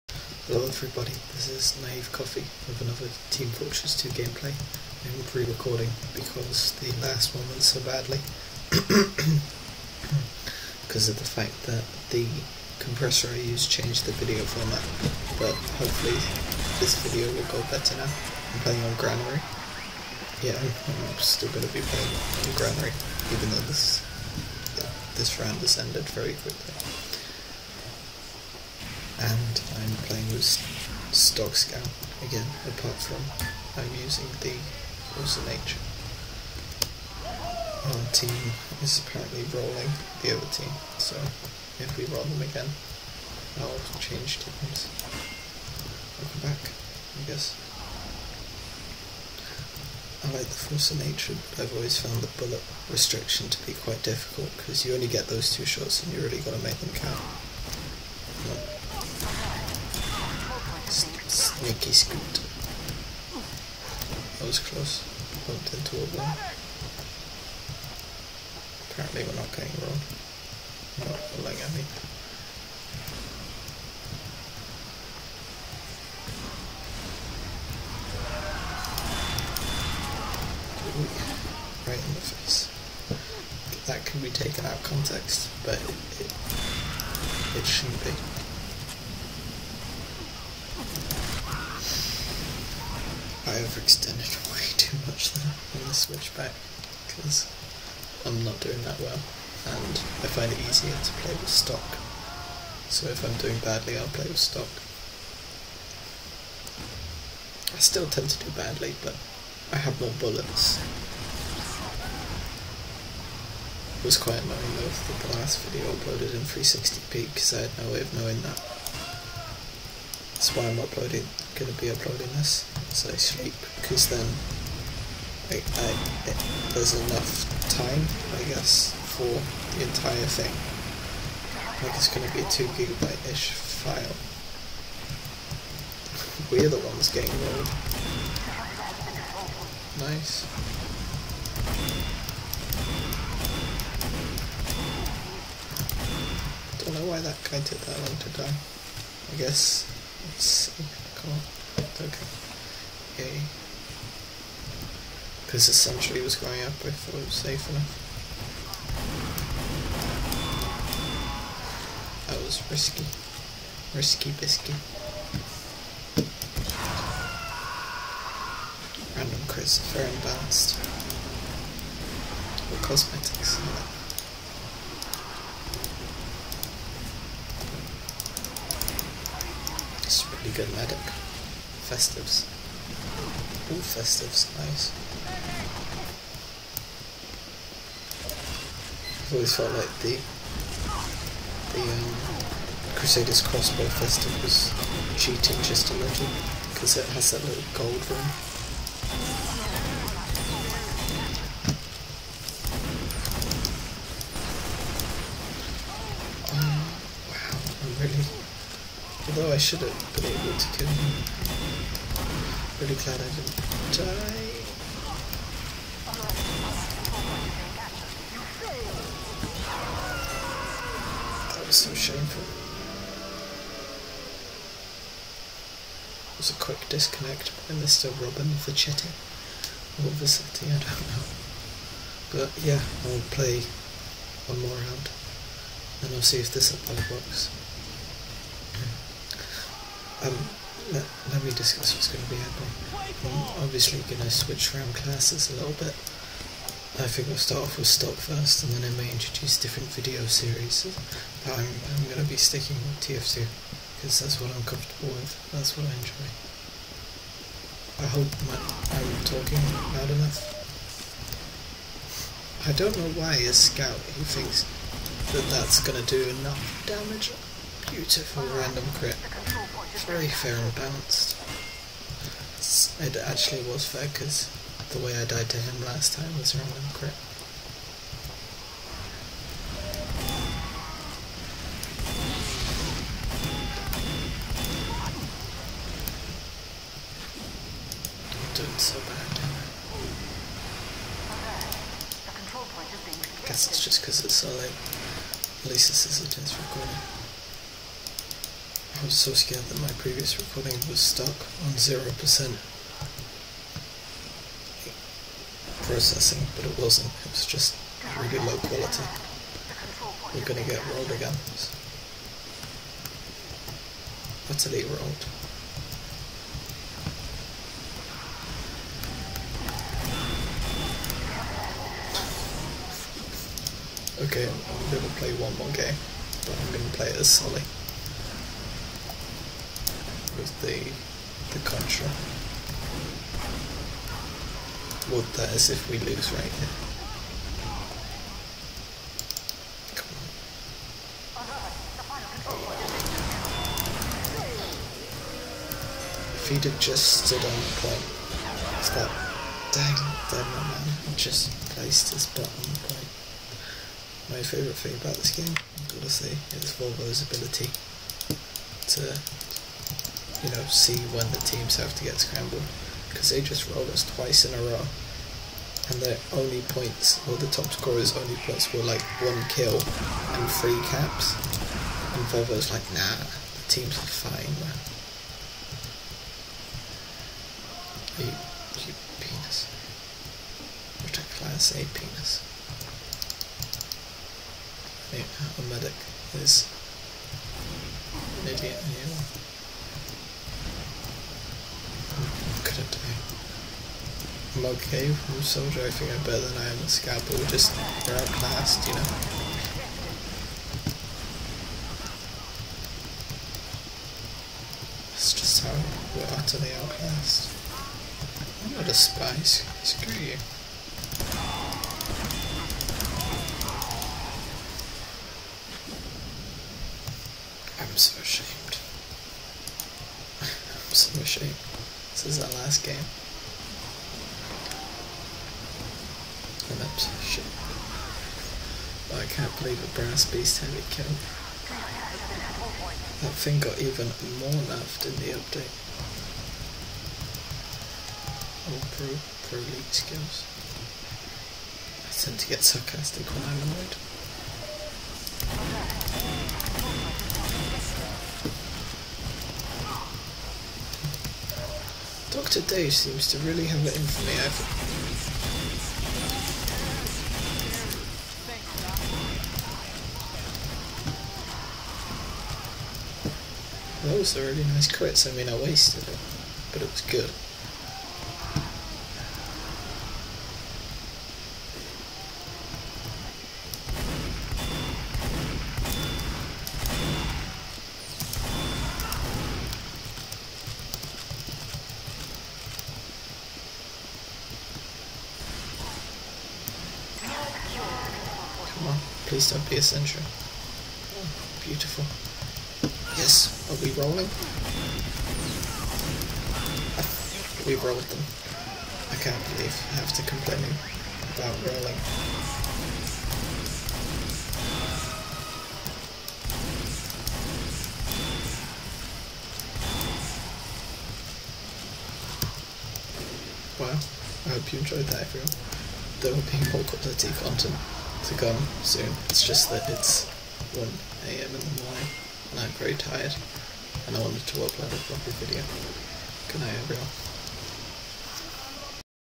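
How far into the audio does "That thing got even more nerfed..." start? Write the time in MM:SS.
07:13.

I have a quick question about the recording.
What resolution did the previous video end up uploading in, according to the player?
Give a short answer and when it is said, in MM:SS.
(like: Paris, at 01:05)
360p, at 01:56.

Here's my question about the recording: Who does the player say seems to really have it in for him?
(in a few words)
Dr. Dave.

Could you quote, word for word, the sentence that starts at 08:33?
Well, I hope you enjoyed that everyone.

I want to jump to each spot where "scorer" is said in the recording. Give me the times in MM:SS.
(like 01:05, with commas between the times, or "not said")
06:07.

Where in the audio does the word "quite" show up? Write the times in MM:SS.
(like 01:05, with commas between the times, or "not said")
00:53, 01:54.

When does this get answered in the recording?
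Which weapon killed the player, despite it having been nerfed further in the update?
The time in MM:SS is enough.
07:09.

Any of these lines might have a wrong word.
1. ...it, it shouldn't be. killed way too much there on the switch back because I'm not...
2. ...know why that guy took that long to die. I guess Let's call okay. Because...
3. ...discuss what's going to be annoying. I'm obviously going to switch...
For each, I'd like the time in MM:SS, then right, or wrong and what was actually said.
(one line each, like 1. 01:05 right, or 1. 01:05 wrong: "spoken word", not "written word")
1. 01:26 wrong: "overextended", not "killed"
2. 02:26 right
3. 04:01 wrong: "happening", not "annoying".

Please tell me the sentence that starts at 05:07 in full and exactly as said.
It was just really low quality.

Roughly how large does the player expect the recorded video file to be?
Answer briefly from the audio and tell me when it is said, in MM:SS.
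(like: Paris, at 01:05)
2 gigabytes, at 02:12.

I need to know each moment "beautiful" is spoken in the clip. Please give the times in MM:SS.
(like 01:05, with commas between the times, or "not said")
04:27, 08:11.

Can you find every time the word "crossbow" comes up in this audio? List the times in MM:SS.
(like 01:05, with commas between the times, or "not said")
03:13.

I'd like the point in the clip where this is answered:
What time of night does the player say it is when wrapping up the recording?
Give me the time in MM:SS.
08:40.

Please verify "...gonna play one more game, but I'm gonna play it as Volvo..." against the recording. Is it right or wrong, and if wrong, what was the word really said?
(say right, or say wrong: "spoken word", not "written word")
wrong: "Sully", not "Volvo".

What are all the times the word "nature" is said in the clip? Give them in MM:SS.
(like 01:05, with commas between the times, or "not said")
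00:35, 00:51.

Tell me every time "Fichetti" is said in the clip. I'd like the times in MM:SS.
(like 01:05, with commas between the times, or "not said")
03:48.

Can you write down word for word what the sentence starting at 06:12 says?
And Volvo's like, nah, the teams are fine, man.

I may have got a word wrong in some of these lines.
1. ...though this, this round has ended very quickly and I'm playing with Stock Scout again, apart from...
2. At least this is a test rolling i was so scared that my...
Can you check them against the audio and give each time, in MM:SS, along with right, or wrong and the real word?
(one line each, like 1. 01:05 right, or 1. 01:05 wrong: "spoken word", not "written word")
1. 00:23 right
2. 04:55 wrong: "recording", not "rolling".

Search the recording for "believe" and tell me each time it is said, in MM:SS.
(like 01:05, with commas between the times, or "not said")
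07:09, 08:19.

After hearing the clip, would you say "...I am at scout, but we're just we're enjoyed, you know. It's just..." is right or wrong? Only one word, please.
wrong.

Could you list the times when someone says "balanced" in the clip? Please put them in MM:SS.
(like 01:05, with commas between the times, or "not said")
02:50, 04:30.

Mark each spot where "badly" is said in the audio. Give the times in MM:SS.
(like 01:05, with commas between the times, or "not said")
00:07, 01:43, 01:48.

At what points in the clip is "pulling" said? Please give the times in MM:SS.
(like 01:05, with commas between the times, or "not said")
not said.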